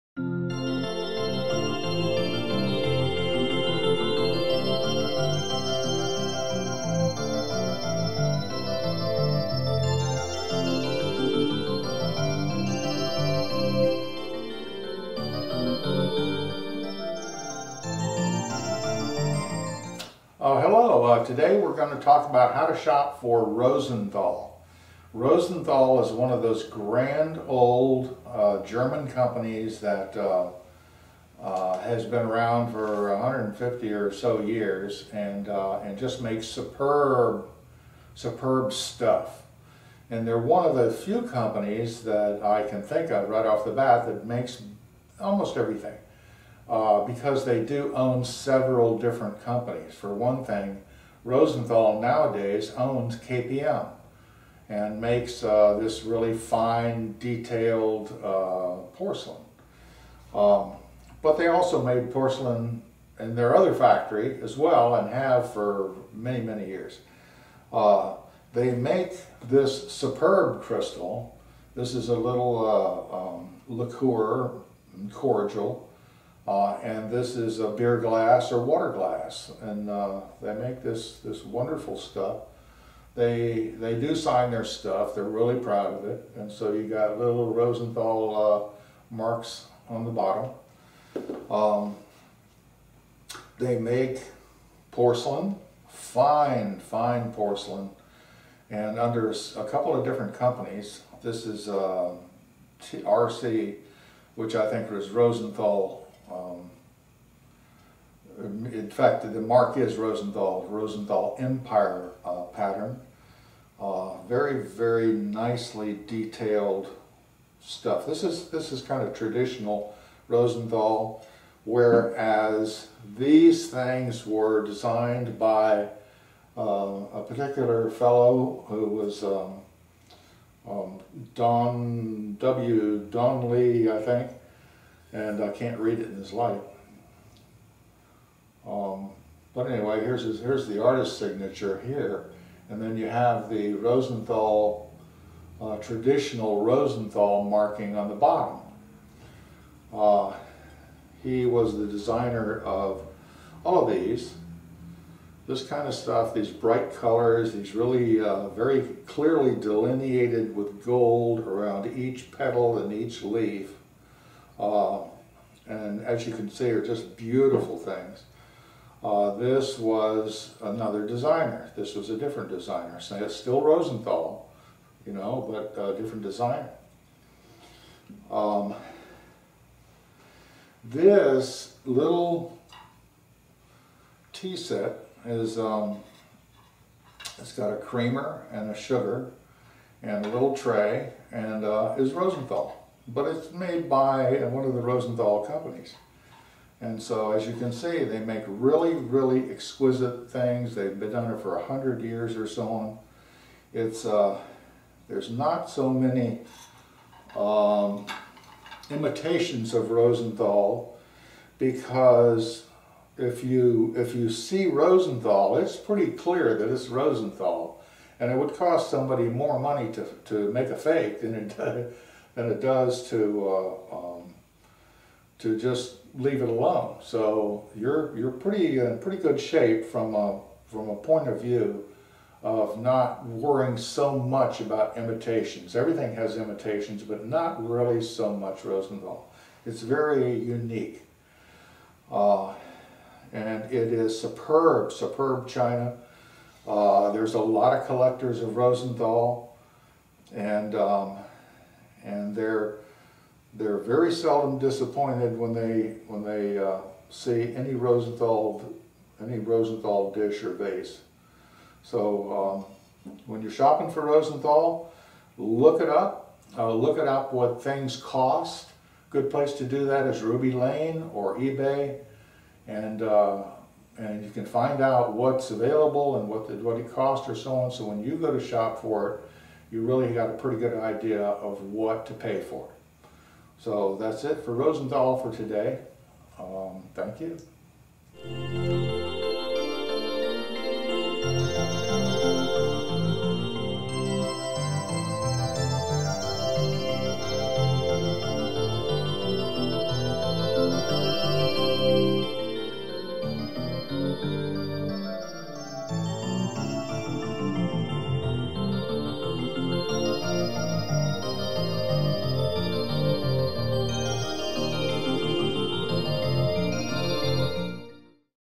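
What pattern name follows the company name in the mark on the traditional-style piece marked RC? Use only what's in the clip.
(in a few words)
Empire.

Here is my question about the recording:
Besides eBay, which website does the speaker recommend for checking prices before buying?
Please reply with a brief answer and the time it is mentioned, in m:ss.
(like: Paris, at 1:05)
Ruby Lane, at 4:30.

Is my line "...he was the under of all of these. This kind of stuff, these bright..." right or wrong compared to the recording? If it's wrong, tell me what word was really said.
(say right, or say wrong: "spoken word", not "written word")
wrong: "designer", not "under".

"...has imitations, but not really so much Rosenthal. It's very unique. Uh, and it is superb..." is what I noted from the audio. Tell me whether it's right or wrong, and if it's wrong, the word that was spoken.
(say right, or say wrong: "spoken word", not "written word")
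right.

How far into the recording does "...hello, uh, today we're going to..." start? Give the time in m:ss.
0:20.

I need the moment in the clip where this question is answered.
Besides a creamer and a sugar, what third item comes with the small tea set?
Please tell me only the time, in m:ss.
3:10.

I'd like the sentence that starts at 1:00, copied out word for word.
Um, but they also made porcelain in their other factory as well and have for many, many years.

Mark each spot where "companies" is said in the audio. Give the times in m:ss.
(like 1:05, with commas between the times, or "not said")
0:29, 0:41, 0:49, 1:40, 3:15.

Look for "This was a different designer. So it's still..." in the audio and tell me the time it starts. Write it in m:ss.
2:51.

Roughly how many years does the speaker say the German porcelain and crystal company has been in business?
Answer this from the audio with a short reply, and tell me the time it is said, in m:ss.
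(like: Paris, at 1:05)
150, at 0:33.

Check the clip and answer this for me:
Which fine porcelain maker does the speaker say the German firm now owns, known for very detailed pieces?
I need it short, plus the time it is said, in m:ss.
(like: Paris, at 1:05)
KPM, at 0:53.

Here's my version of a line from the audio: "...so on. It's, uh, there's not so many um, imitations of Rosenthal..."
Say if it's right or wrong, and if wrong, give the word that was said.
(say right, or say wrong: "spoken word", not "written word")
right.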